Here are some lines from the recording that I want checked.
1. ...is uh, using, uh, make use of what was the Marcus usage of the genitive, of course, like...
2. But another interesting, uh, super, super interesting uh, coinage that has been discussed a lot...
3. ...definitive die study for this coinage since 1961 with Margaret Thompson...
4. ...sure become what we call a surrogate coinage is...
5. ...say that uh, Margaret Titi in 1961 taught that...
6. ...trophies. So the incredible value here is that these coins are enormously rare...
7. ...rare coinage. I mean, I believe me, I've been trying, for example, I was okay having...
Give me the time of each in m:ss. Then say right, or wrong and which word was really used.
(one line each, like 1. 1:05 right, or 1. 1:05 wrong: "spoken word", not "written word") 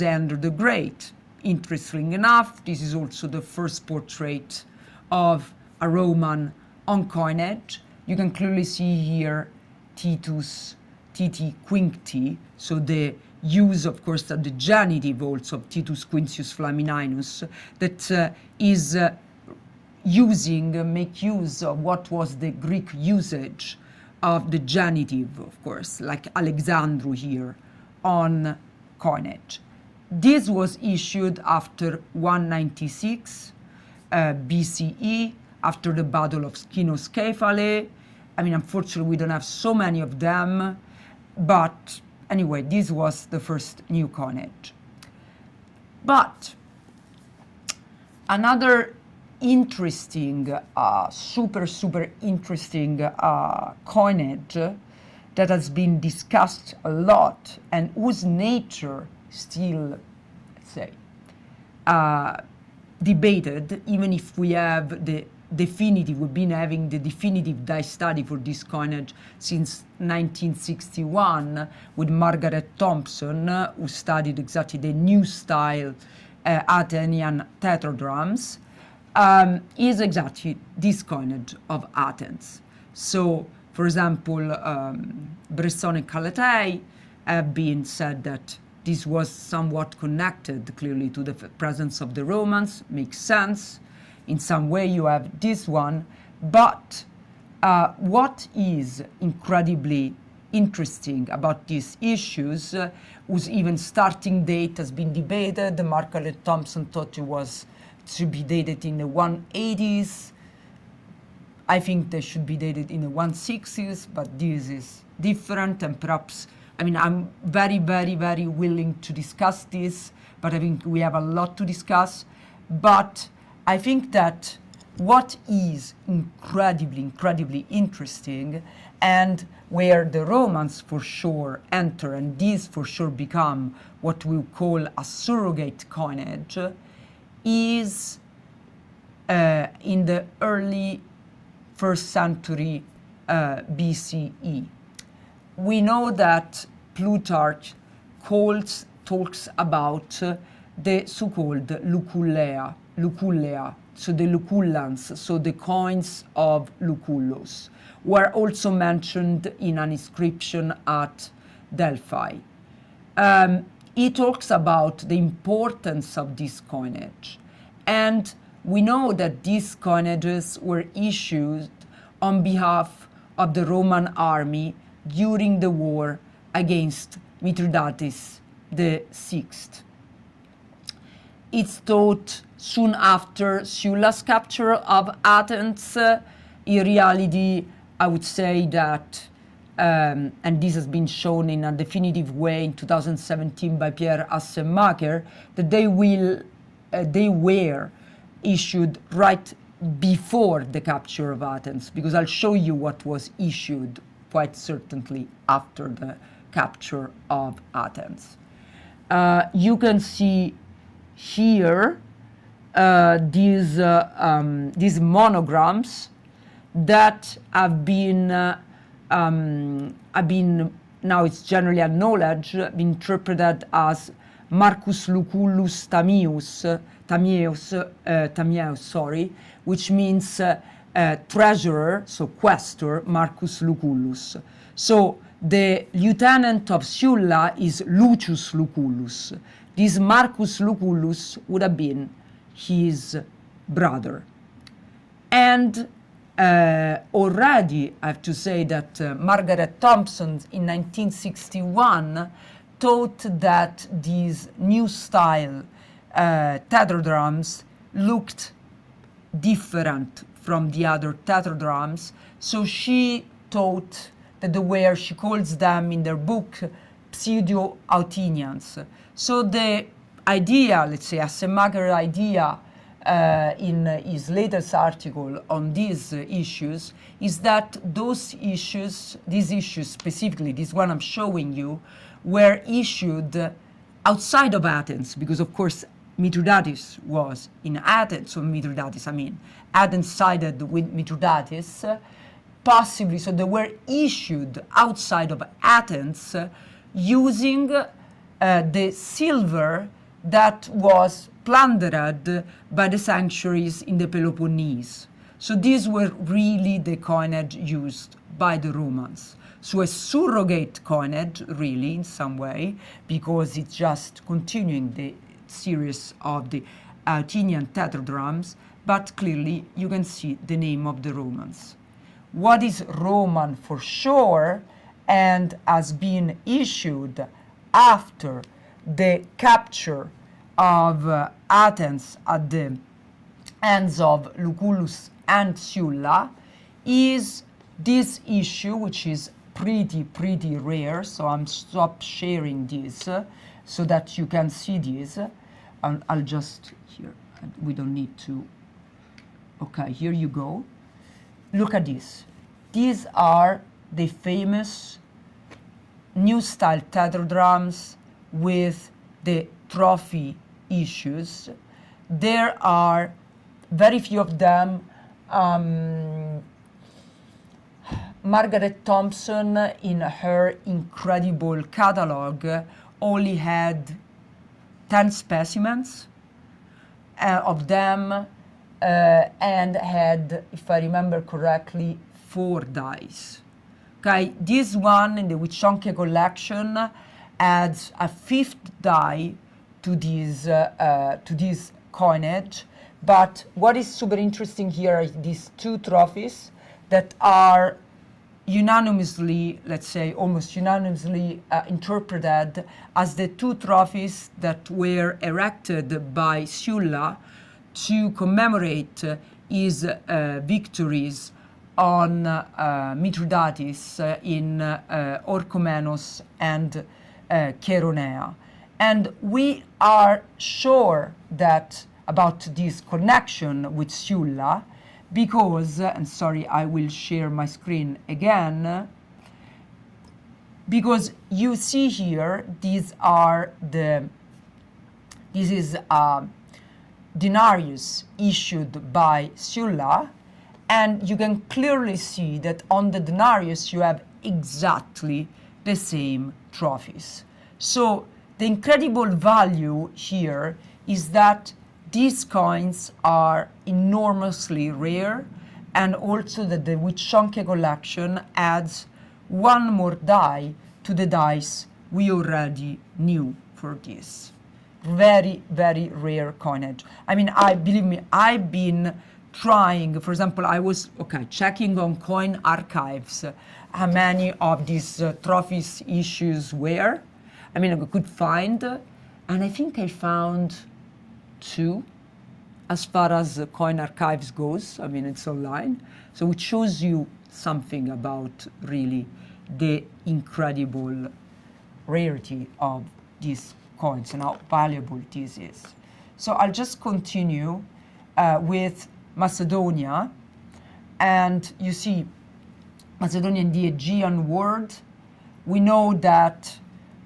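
1. 0:18 wrong: "Greek", not "Marcus"
2. 0:46 right
3. 1:06 right
4. 2:12 right
5. 4:08 wrong: "Thompson", not "Titi"
6. 7:26 right
7. 7:45 wrong: "checking", not "having".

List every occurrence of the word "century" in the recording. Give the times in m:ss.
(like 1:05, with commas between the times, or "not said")
2:22.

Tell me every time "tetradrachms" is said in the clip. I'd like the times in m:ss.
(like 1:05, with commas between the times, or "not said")
1:17, 4:16, 4:21, 5:17.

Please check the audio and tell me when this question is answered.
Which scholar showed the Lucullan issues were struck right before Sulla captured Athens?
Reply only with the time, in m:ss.
3:13.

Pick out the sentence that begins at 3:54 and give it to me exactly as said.
So the lieutenant of Sulla is Lucius Lucullus.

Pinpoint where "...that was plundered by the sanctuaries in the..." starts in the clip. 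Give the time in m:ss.
5:00.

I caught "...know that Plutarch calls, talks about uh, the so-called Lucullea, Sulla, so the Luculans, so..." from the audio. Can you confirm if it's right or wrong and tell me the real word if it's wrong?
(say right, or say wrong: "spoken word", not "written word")
wrong: "Lucullea", not "Sulla".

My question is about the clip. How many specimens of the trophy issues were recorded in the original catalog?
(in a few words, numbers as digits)
10.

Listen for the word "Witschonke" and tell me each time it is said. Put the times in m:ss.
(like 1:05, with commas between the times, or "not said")
6:25, 7:36.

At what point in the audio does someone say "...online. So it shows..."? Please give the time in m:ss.
8:05.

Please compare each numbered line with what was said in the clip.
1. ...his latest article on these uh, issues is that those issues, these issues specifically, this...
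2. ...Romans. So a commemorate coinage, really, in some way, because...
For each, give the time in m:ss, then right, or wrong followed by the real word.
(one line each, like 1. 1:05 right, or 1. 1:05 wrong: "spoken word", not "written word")
1. 4:34 right
2. 5:08 wrong: "surrogate", not "commemorate".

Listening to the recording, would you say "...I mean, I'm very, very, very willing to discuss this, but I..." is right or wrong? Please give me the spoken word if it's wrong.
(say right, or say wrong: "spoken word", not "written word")
right.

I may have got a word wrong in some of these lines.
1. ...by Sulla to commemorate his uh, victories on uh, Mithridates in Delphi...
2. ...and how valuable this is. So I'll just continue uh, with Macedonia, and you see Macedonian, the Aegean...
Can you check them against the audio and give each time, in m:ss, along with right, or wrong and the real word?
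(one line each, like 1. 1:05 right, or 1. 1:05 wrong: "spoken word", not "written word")
1. 6:46 wrong: "Orchomenos", not "Delphi"
2. 8:14 right.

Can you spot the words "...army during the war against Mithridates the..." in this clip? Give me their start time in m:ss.
2:54.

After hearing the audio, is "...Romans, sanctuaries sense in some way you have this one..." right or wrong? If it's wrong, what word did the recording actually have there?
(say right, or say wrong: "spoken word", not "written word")
wrong: "makes", not "sanctuaries".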